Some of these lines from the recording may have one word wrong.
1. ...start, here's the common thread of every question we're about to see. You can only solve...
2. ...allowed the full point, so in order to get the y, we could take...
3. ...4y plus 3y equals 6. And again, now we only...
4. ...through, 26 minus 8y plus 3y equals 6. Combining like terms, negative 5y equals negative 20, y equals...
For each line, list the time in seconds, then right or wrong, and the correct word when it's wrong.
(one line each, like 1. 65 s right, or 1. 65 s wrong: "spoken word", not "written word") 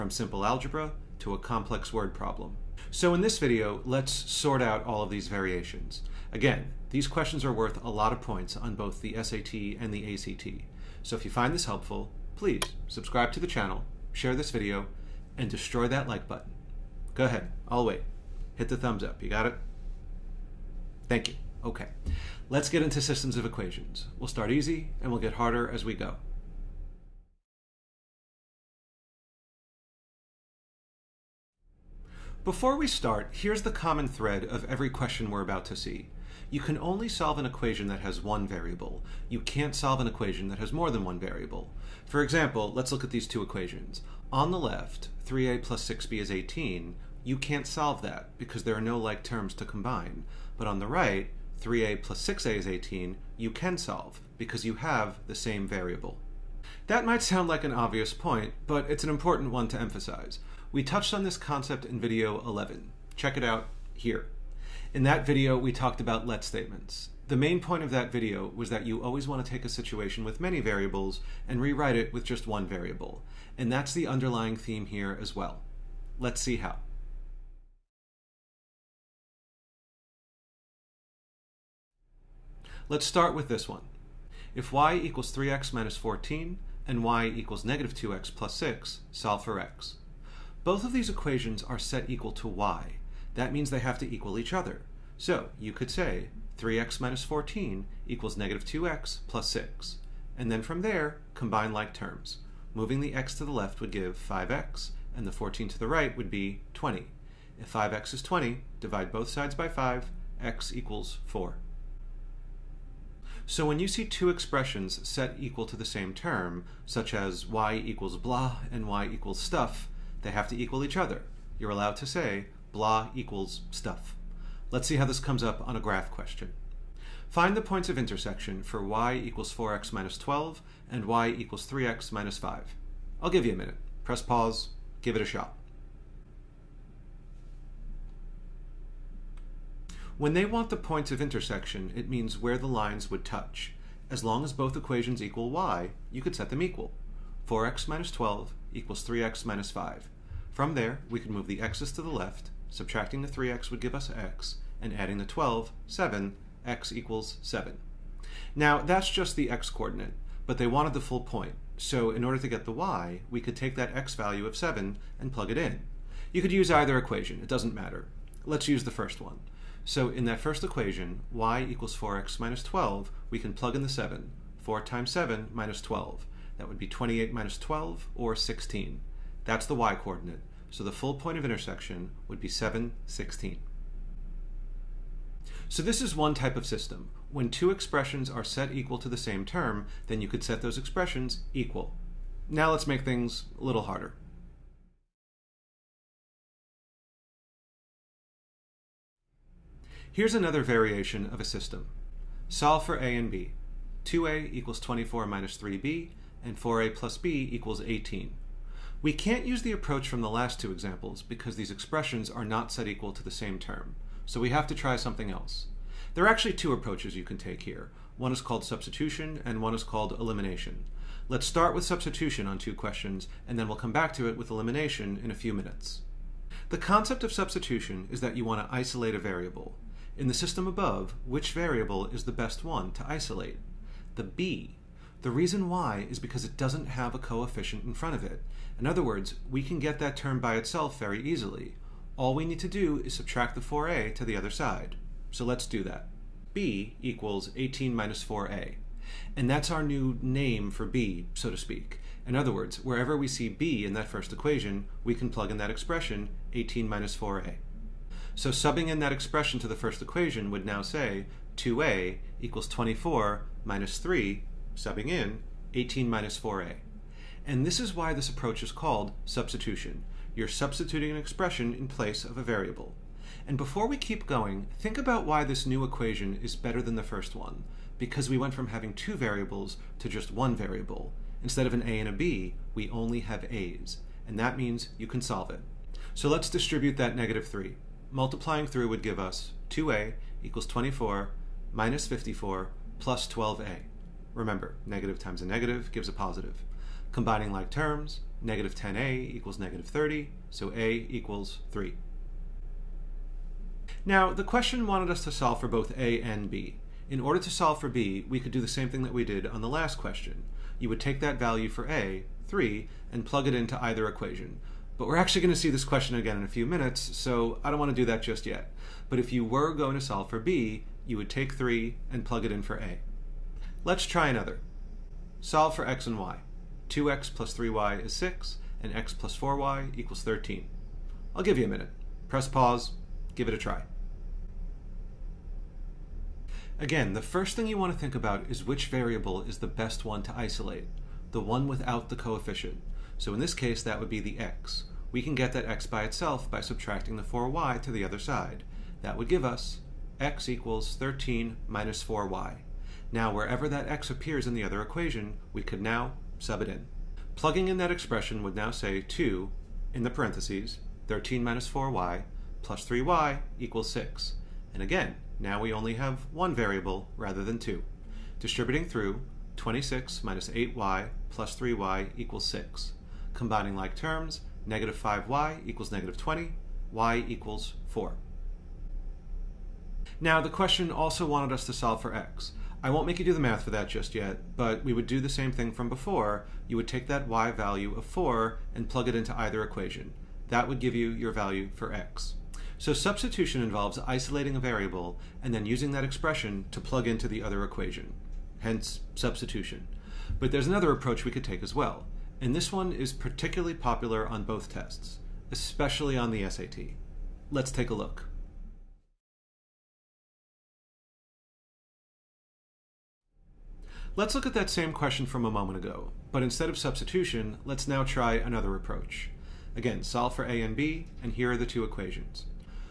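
1. 32 s right
2. 160 s wrong: "wanted", not "allowed"
3. 361 s right
4. 368 s right.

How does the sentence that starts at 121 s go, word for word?
You're allowed to say blah equals stuff.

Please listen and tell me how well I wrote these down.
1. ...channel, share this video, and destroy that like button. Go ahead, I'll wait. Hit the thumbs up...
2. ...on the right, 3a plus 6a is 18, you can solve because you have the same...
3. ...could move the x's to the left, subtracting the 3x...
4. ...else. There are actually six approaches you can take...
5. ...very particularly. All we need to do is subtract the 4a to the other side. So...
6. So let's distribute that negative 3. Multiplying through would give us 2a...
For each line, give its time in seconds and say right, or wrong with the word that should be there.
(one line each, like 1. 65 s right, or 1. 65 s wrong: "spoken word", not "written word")
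1. 13 s right
2. 50 s right
3. 151 s right
4. 215 s wrong: "two", not "six"
5. 240 s wrong: "easily", not "particularly"
6. 286 s right.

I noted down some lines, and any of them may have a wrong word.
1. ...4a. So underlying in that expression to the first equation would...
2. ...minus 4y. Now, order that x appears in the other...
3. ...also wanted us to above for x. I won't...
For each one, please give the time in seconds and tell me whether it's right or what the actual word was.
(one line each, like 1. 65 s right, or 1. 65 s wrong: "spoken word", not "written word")
1. 257 s wrong: "subbing", not "underlying"
2. 351 s wrong: "wherever", not "order"
3. 380 s wrong: "solve", not "above".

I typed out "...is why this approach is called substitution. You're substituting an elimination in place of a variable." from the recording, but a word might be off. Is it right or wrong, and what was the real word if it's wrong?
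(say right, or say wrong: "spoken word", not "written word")
wrong: "expression", not "elimination".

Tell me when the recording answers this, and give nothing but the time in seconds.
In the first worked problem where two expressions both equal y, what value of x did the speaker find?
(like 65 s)
110 s.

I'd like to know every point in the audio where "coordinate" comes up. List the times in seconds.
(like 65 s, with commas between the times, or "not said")
159 s, 179 s.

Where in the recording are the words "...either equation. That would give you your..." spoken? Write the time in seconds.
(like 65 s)
389 s.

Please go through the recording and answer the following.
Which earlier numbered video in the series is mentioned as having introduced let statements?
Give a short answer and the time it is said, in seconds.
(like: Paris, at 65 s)
video 11, at 61 s.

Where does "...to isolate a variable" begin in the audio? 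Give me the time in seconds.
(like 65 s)
228 s.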